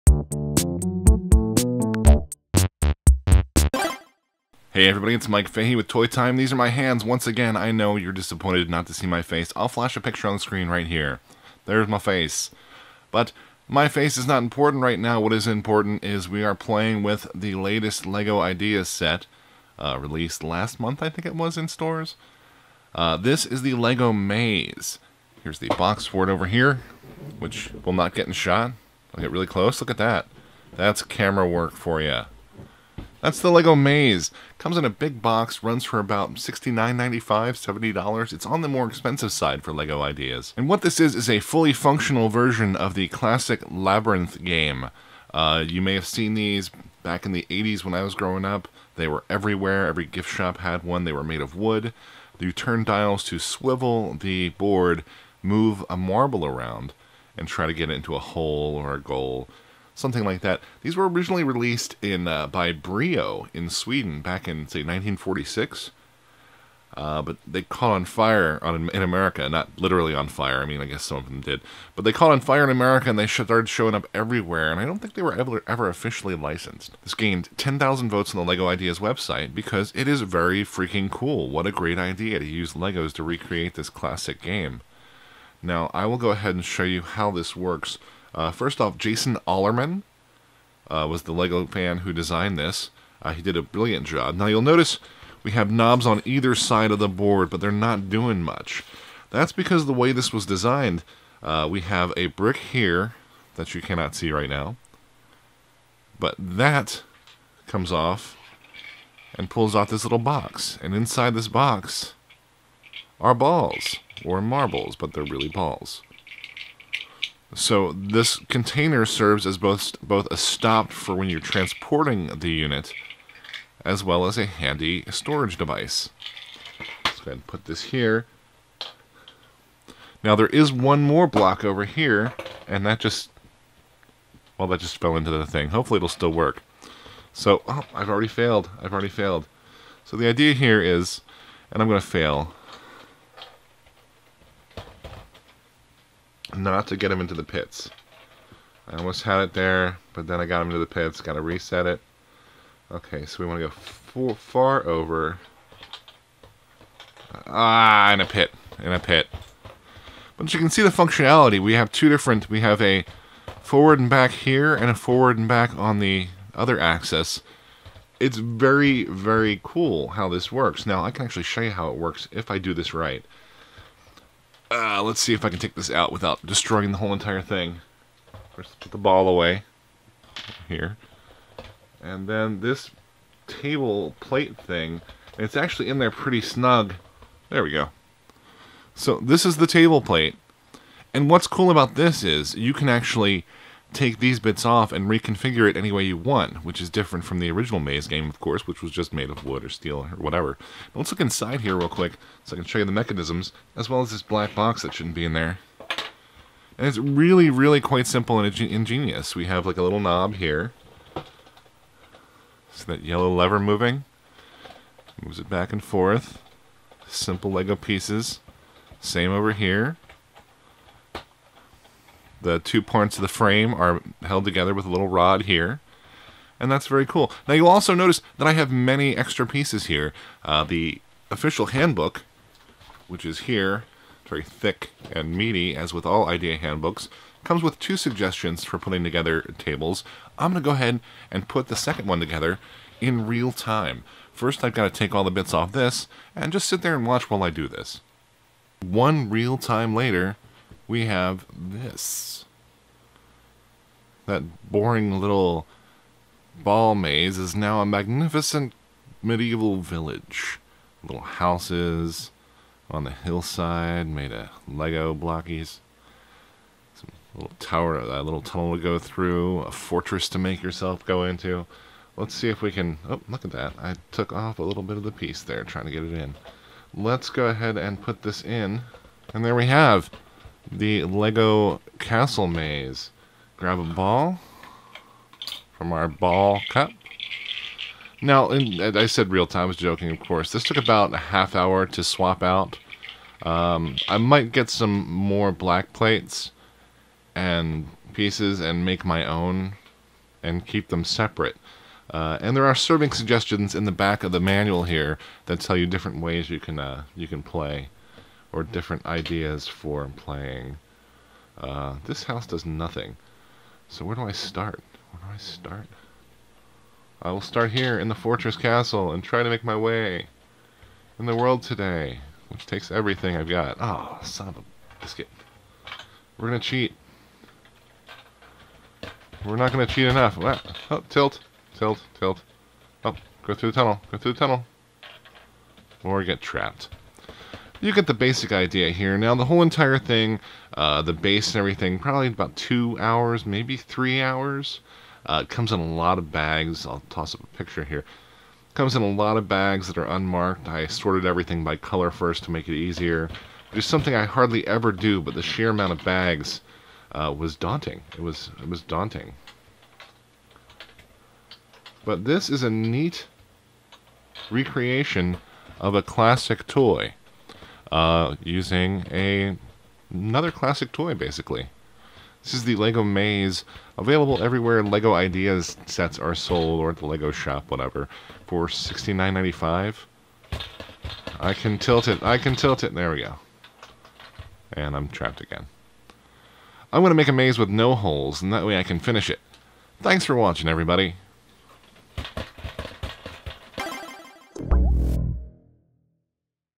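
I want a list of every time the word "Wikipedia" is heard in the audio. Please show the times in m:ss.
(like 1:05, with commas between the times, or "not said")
not said.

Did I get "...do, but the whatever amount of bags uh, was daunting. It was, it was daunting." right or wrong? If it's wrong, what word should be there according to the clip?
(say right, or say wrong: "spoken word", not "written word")
wrong: "sheer", not "whatever".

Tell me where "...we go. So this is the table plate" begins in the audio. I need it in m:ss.
3:07.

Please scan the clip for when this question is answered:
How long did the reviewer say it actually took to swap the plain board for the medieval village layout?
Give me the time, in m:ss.
4:51.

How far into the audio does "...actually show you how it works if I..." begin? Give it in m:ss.
2:51.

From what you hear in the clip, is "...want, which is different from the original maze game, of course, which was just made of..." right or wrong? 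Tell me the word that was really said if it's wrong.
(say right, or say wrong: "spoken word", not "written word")
right.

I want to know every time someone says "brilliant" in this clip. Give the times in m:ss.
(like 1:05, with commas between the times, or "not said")
1:33.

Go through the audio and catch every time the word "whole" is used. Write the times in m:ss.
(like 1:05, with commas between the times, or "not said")
2:56, 5:39.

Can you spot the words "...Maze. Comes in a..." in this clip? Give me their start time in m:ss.
0:33.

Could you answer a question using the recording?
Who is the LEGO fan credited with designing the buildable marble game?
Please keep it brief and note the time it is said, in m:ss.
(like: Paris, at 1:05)
Jason Allemann, at 1:28.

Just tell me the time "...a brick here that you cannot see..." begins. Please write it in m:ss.
1:42.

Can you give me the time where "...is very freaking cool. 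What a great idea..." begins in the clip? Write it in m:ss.
1:20.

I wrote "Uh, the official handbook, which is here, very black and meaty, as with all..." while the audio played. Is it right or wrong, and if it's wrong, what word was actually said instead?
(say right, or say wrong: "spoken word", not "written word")
wrong: "thick", not "black".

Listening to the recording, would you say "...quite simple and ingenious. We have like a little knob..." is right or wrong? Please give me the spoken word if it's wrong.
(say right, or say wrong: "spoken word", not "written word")
right.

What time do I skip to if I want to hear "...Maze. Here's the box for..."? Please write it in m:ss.
0:24.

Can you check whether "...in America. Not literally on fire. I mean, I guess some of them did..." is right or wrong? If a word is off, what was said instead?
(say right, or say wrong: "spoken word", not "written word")
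right.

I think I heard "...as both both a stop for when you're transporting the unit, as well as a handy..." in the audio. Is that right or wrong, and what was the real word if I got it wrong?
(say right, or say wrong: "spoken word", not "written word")
right.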